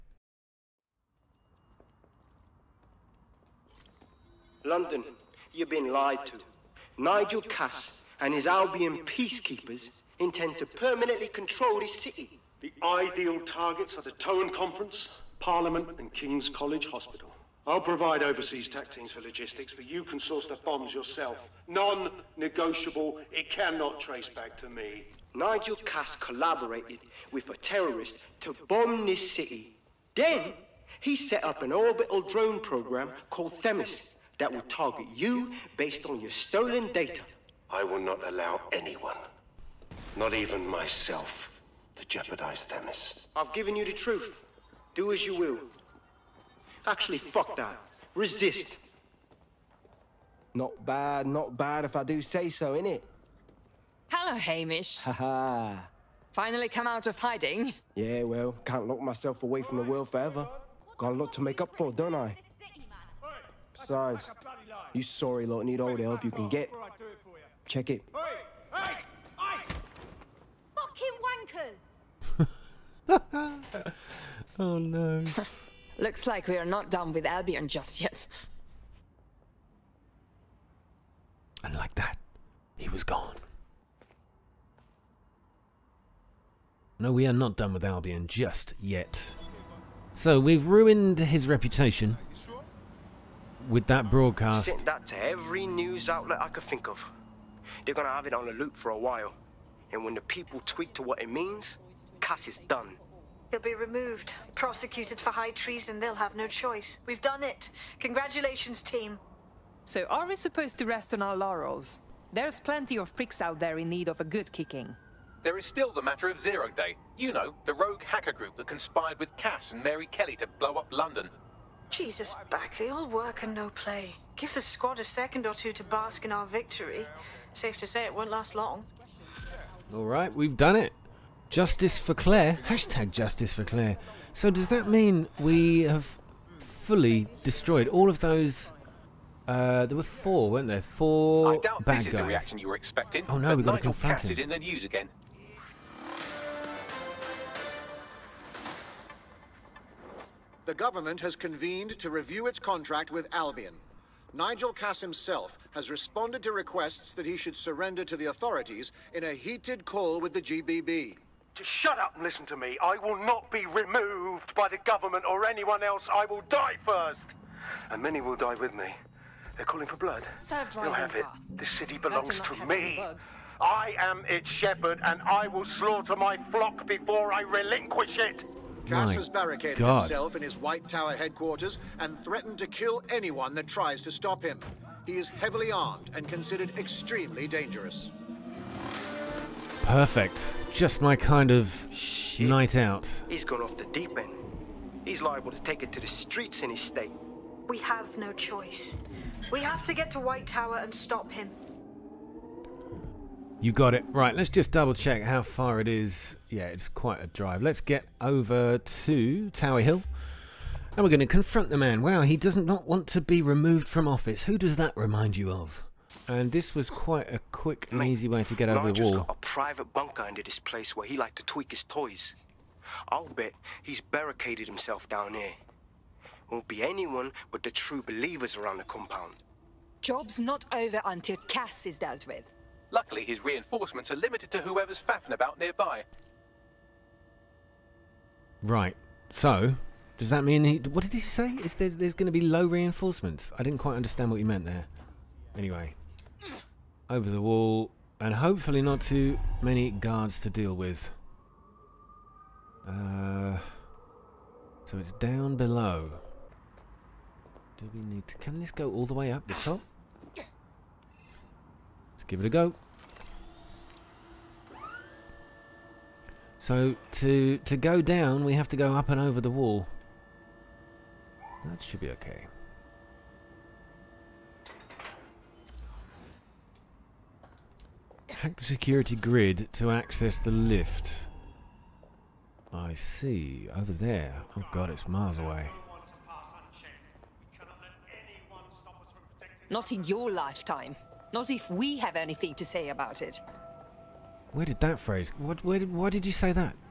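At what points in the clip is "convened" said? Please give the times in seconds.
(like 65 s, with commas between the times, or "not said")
151 s.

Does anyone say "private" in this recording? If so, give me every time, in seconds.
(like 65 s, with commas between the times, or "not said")
219 s.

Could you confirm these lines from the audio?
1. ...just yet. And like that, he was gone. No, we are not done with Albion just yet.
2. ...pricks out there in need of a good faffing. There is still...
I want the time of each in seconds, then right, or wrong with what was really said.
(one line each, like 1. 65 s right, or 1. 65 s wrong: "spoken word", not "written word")
1. 77 s right
2. 113 s wrong: "kicking", not "faffing".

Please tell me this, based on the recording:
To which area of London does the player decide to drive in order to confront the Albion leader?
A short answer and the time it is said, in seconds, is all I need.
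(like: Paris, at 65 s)
Tower Hill, at 209 s.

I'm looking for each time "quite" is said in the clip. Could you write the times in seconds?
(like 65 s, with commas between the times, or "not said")
206 s, 216 s, 243 s.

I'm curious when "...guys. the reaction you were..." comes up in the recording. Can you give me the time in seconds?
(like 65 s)
142 s.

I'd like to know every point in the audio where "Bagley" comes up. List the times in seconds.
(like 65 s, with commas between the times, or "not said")
122 s.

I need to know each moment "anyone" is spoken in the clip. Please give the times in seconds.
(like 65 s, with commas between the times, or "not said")
38 s, 165 s, 183 s, 226 s.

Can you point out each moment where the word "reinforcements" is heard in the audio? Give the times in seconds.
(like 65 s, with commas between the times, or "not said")
233 s, 242 s.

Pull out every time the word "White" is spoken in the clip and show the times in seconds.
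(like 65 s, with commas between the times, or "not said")
180 s, 200 s.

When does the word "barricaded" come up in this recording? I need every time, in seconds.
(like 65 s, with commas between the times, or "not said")
179 s, 223 s.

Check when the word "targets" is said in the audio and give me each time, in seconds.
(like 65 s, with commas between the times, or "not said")
13 s, 34 s.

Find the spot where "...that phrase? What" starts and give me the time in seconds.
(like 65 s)
294 s.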